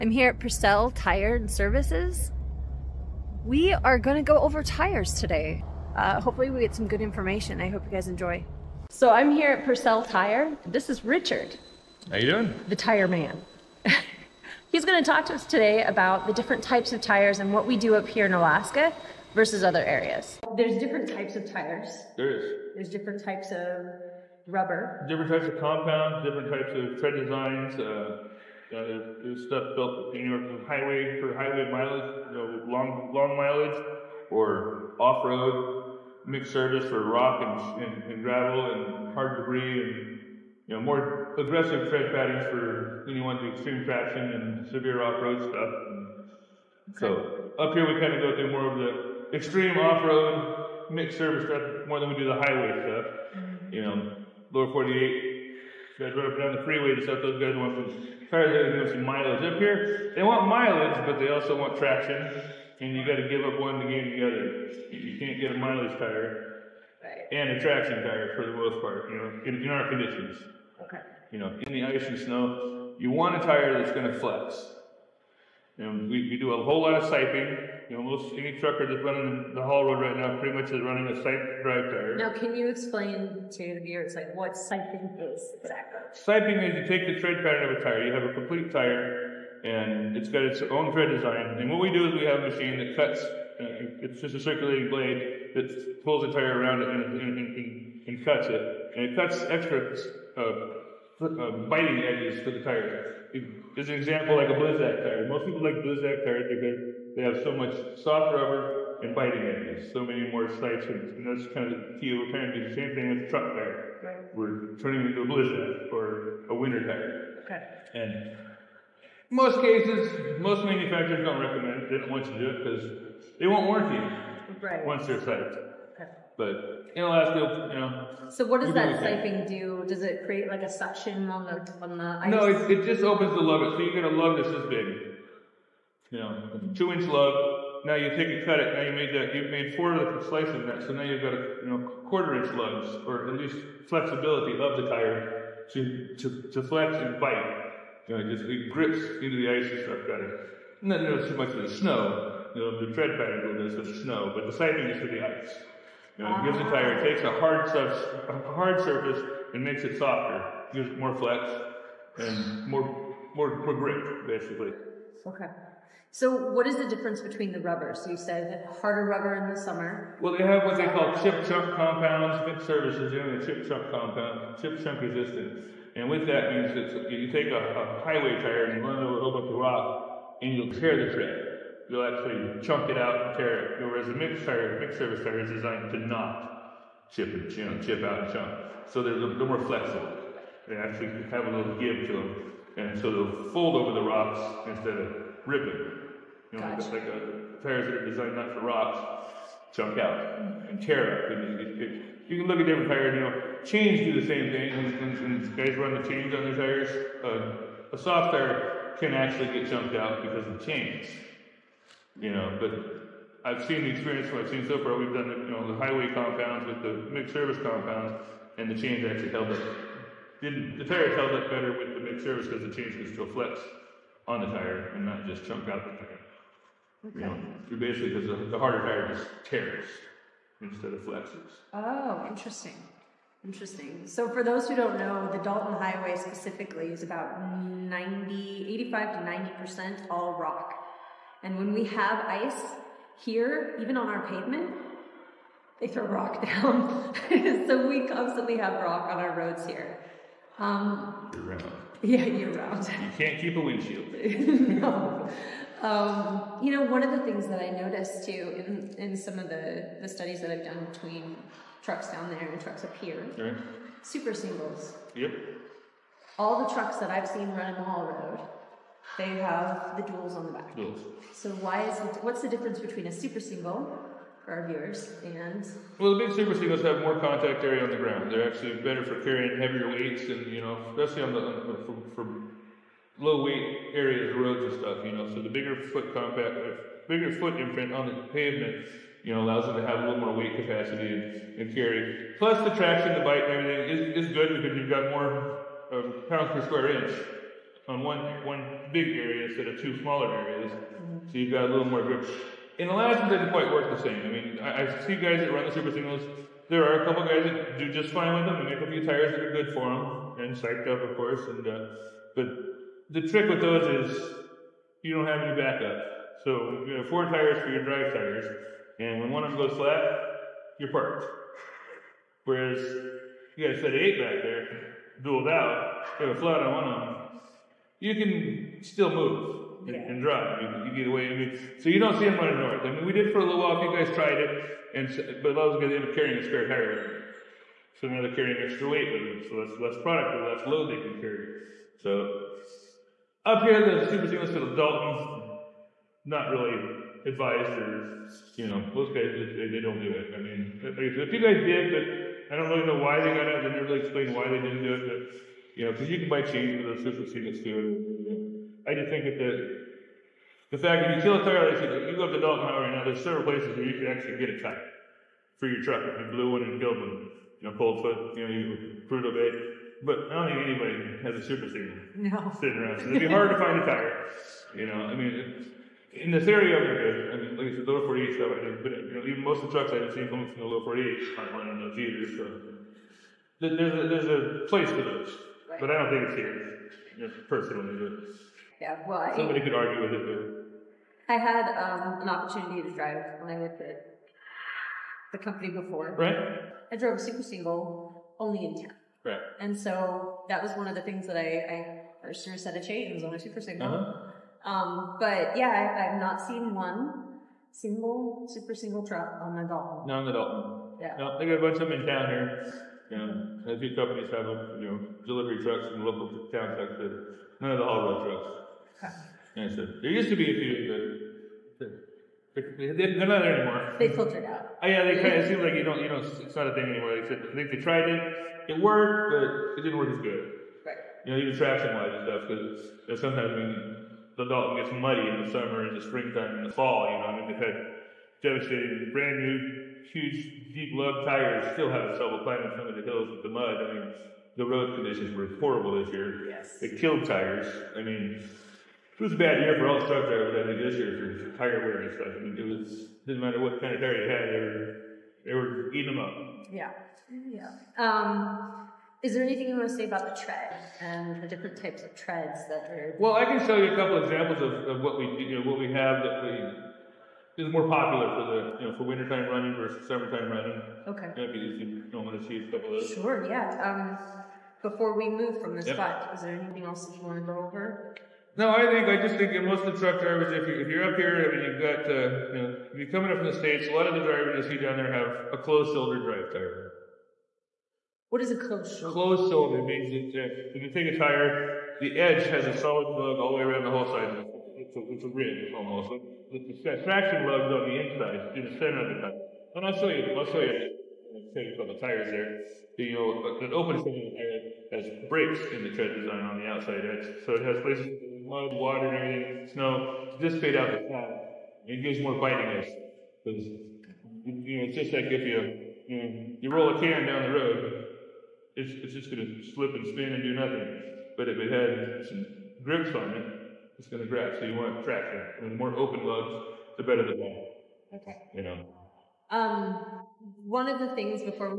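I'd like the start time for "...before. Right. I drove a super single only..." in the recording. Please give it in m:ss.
6:35.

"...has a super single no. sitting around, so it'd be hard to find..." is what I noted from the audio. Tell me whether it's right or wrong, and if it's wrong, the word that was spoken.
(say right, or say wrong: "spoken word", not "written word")
right.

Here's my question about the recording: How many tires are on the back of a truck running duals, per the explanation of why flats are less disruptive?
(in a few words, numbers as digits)
8.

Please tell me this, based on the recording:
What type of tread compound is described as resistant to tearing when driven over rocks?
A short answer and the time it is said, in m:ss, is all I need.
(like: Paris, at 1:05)
chip chunk compound, at 2:53.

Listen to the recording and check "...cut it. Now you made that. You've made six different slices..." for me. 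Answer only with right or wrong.
wrong.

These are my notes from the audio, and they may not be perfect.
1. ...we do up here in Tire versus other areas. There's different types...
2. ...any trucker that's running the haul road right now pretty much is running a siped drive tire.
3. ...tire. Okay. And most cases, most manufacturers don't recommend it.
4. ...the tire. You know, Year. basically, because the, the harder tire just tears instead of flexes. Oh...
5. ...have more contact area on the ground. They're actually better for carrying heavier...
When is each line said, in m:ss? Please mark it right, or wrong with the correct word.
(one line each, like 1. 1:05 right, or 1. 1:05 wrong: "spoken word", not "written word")
1. 0:17 wrong: "Alaska", not "Tire"
2. 1:18 right
3. 1:56 right
4. 3:45 wrong: "Okay", not "Year"
5. 4:36 right.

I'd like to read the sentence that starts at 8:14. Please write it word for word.
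It's a, it's a ridge almost.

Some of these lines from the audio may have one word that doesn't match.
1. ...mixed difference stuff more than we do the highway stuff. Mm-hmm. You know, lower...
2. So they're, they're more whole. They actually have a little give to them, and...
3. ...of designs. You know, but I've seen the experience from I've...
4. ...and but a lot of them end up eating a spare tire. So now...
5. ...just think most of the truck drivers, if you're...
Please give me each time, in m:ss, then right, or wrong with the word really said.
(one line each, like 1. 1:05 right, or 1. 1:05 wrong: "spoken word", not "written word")
1. 0:50 wrong: "service", not "difference"
2. 3:08 wrong: "flexible", not "whole"
3. 3:30 wrong: "chains", not "designs"
4. 5:34 wrong: "carrying", not "eating"
5. 7:59 right.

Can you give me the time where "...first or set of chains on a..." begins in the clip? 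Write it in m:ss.
6:42.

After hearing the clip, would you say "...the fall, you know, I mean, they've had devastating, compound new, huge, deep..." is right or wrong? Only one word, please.
wrong.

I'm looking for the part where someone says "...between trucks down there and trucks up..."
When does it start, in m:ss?
4:20.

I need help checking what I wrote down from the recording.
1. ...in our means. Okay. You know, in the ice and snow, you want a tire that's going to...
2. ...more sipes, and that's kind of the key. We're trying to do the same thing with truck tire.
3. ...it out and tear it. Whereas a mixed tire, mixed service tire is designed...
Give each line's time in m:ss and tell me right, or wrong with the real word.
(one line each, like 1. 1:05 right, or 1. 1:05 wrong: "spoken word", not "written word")
1. 1:09 wrong: "conditions", not "means"
2. 1:50 right
3. 3:02 right.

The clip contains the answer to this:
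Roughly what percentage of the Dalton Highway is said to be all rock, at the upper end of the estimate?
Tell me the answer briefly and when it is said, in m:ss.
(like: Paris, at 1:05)
90 percent, at 3:59.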